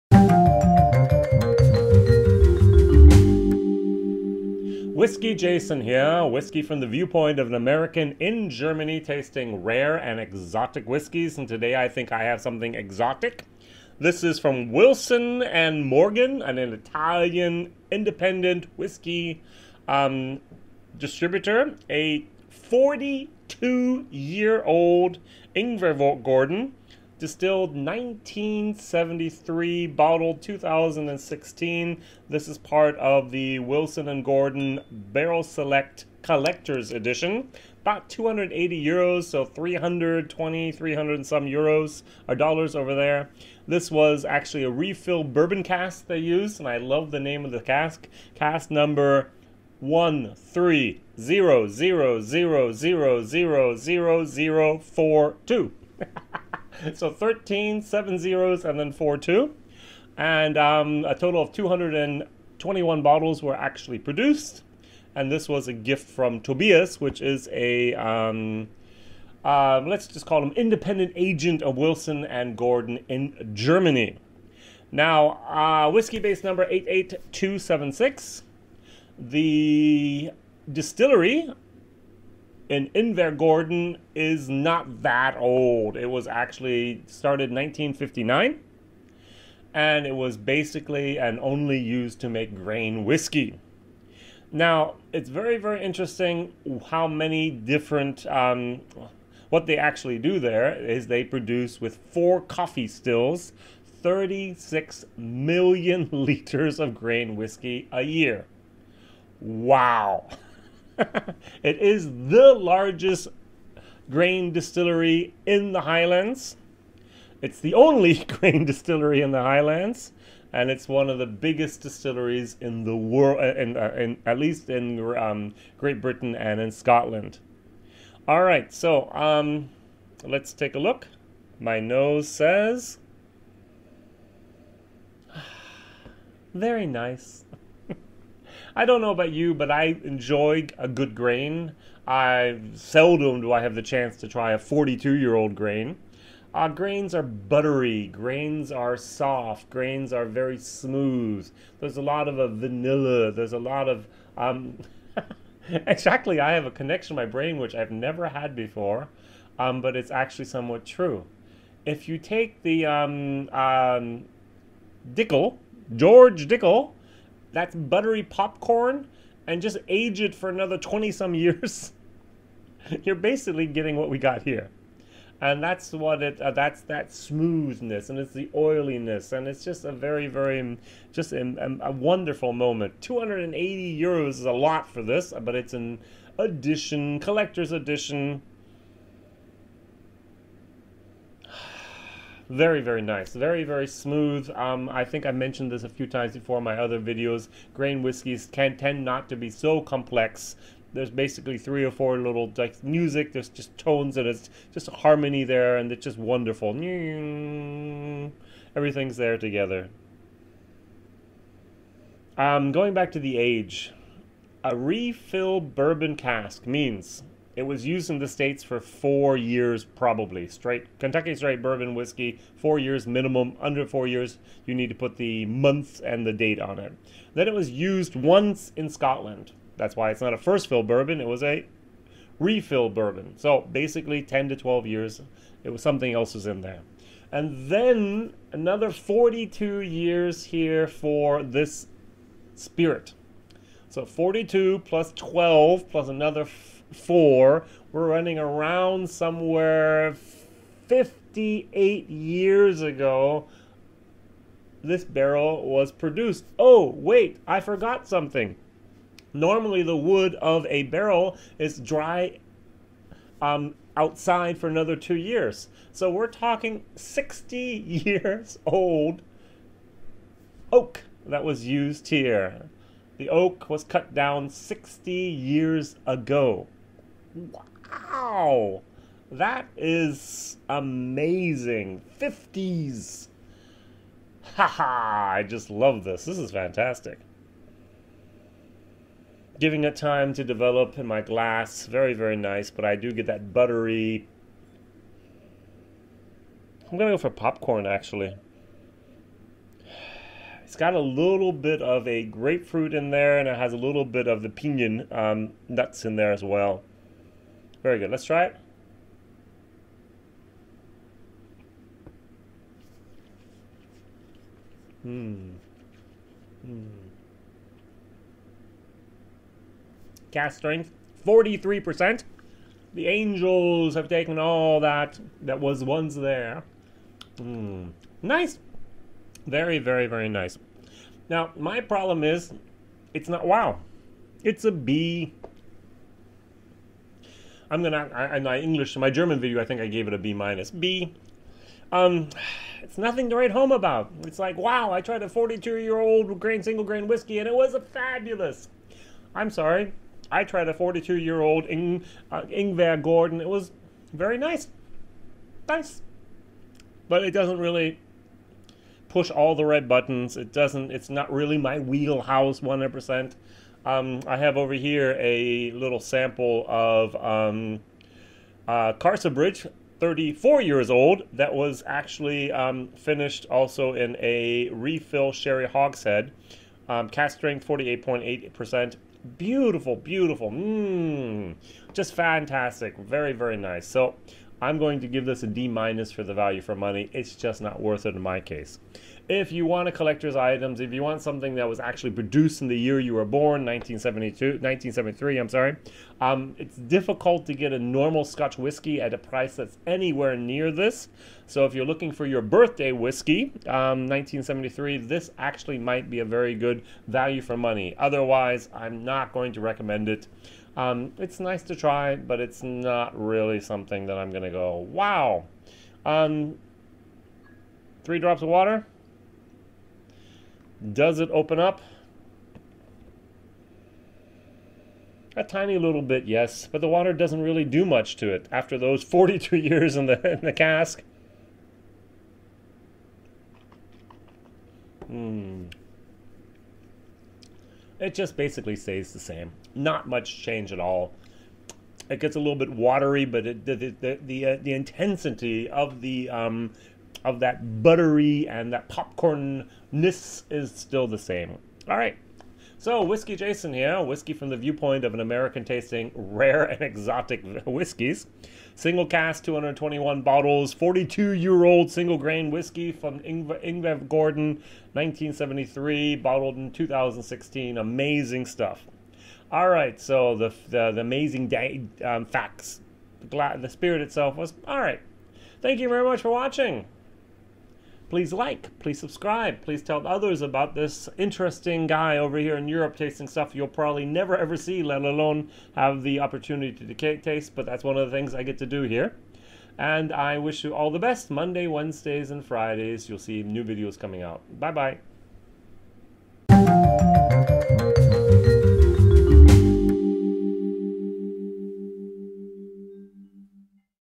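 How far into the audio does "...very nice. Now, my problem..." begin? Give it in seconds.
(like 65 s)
330 s.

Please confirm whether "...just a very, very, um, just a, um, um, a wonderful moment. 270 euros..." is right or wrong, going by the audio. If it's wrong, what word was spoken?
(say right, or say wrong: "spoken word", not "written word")
wrong: "280", not "270".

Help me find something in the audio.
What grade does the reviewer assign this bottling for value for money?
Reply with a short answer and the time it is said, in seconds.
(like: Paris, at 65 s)
D minus, at 385 s.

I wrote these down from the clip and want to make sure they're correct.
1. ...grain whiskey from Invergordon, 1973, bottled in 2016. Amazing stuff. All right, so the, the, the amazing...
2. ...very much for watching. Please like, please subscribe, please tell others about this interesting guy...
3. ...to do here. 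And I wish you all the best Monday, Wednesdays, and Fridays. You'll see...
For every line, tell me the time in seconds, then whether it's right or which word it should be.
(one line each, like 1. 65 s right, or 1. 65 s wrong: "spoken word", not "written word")
1. 462 s right
2. 475 s right
3. 488 s right.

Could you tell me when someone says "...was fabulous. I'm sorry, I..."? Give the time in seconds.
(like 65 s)
347 s.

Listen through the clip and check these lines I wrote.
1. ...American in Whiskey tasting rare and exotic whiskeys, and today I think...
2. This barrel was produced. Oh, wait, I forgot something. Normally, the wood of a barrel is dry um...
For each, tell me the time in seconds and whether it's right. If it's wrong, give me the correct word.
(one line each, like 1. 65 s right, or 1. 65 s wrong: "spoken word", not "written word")
1. 7 s wrong: "Germany", not "Whiskey"
2. 254 s right.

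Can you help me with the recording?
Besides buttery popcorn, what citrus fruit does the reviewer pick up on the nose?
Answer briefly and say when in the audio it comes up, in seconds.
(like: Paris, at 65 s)
grapefruit, at 302 s.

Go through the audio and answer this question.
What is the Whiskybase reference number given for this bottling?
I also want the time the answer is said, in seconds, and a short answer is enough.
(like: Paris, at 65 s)
88276, at 76 s.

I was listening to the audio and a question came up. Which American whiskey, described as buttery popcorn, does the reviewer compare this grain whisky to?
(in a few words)
George Dickel.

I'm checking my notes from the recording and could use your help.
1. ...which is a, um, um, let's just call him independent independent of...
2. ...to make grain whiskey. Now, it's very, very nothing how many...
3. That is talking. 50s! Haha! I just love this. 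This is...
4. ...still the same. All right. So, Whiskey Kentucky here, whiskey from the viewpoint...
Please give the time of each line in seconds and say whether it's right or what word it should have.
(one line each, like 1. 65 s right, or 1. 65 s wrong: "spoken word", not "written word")
1. 67 s wrong: "agent", not "independent"
2. 92 s wrong: "interesting", not "nothing"
3. 279 s wrong: "amazing", not "talking"
4. 450 s wrong: "Jason", not "Kentucky".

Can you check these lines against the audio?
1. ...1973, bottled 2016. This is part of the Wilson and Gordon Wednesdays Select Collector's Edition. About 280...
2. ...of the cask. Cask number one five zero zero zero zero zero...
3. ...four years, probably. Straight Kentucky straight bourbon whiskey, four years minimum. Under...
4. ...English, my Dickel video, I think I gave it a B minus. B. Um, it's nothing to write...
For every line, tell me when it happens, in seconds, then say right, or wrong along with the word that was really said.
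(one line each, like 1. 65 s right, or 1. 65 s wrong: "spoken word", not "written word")
1. 27 s wrong: "Barrel", not "Wednesdays"
2. 47 s wrong: "three", not "five"
3. 218 s right
4. 338 s wrong: "German", not "Dickel".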